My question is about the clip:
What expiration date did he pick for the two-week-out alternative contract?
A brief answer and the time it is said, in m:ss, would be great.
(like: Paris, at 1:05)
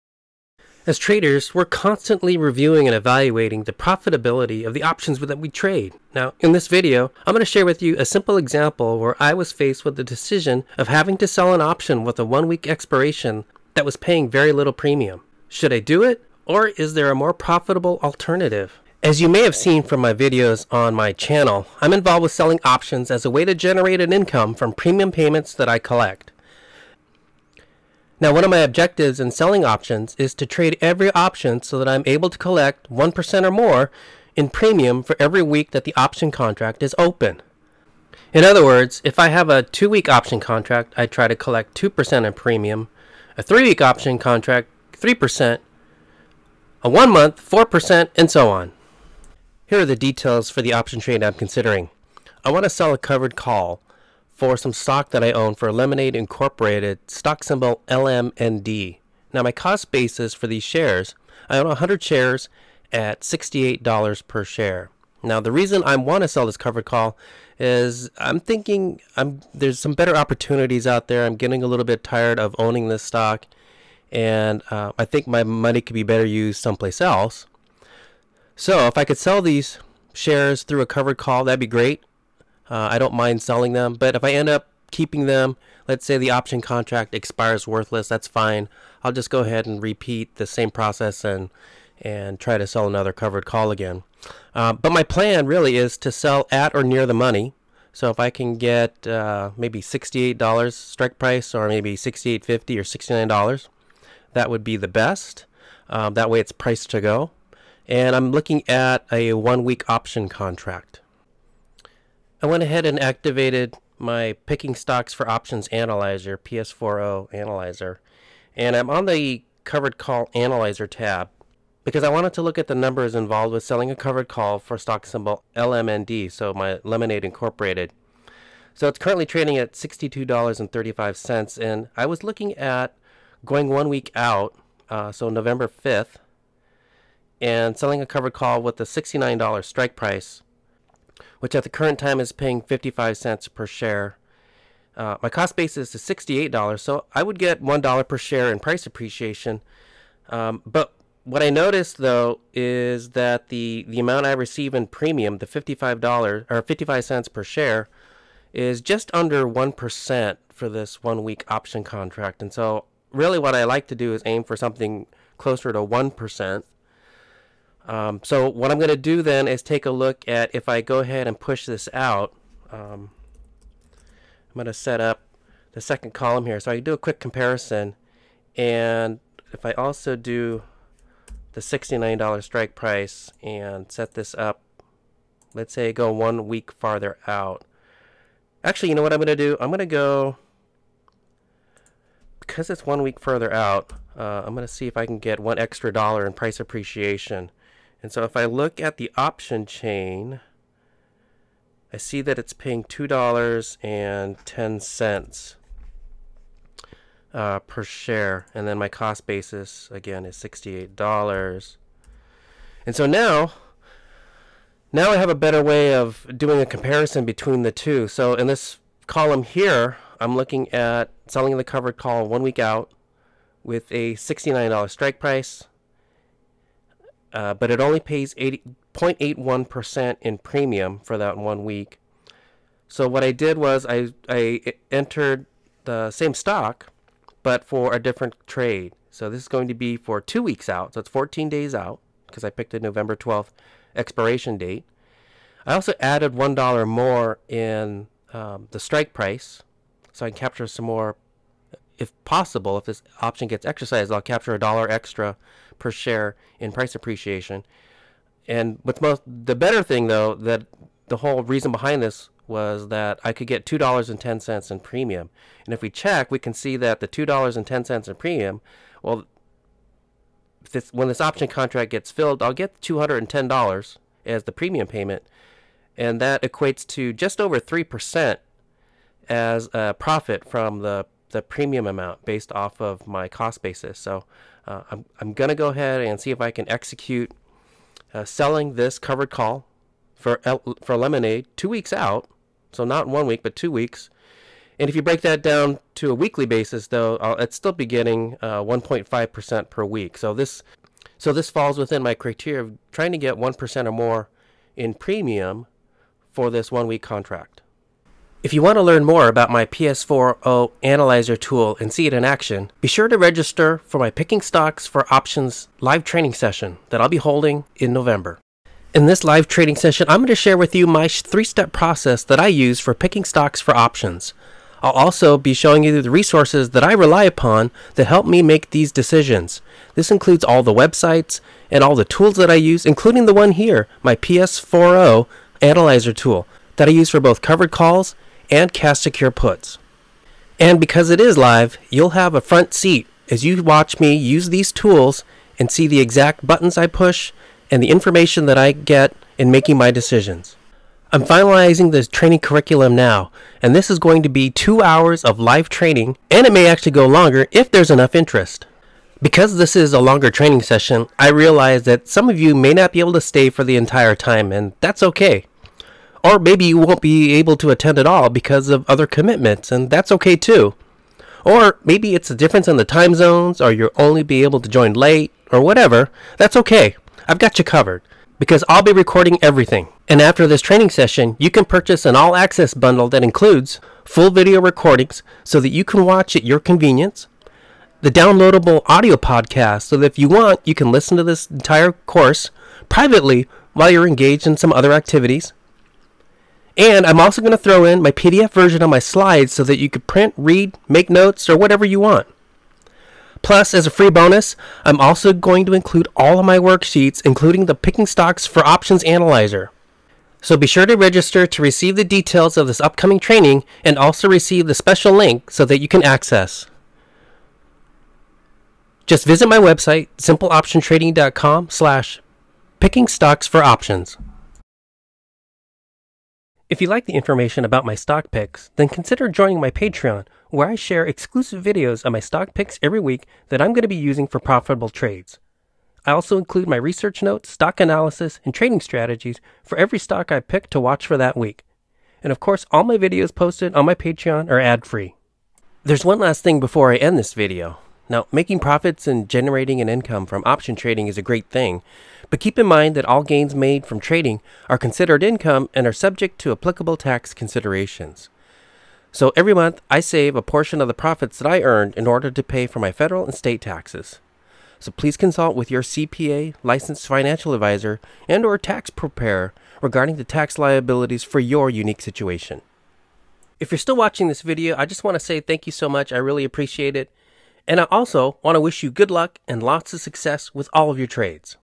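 November 12th, at 4:02.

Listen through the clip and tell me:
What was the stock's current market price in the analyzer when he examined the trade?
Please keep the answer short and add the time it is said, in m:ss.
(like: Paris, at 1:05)
$62.35, at 2:09.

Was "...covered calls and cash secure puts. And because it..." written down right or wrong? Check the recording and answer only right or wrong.
right.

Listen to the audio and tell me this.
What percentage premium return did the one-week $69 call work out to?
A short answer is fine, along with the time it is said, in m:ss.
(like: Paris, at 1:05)
0.81%, at 3:48.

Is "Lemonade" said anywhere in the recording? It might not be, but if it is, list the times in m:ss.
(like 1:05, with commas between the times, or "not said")
0:55, 2:06, 4:50.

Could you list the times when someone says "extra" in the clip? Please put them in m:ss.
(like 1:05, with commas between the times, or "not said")
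3:15, 4:14.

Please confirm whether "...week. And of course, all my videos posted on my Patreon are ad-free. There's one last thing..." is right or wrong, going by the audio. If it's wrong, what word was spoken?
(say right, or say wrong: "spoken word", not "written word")
right.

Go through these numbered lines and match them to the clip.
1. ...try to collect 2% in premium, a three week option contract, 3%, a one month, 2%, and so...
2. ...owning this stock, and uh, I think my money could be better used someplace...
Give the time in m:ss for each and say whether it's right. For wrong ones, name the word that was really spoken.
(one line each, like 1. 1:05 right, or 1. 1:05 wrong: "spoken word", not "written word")
1. 0:41 wrong: "4", not "2"
2. 1:12 right.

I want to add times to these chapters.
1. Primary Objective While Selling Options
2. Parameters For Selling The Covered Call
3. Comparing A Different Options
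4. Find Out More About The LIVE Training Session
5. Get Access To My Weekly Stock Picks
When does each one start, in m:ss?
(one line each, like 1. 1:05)
1. 0:27
2. 0:49
3. 2:53
4. 5:08
5. 7:06.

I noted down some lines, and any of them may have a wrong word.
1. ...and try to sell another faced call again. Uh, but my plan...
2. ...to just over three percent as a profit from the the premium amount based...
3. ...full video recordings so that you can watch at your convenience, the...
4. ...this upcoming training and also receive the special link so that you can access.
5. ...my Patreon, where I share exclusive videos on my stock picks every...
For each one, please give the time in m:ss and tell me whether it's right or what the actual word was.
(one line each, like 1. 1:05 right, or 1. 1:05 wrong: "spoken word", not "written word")
1. 1:32 wrong: "covered", not "faced"
2. 4:36 right
3. 6:24 right
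4. 6:52 right
5. 7:09 right.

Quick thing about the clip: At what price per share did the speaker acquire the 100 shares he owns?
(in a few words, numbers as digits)
$68.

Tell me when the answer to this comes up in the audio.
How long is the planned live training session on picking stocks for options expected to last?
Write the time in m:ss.
5:54.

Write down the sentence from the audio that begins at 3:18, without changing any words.
And so if I look at the option chain, I see that it's paying $2.10 uh, per share.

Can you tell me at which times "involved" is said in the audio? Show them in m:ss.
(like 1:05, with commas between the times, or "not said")
0:21, 2:03.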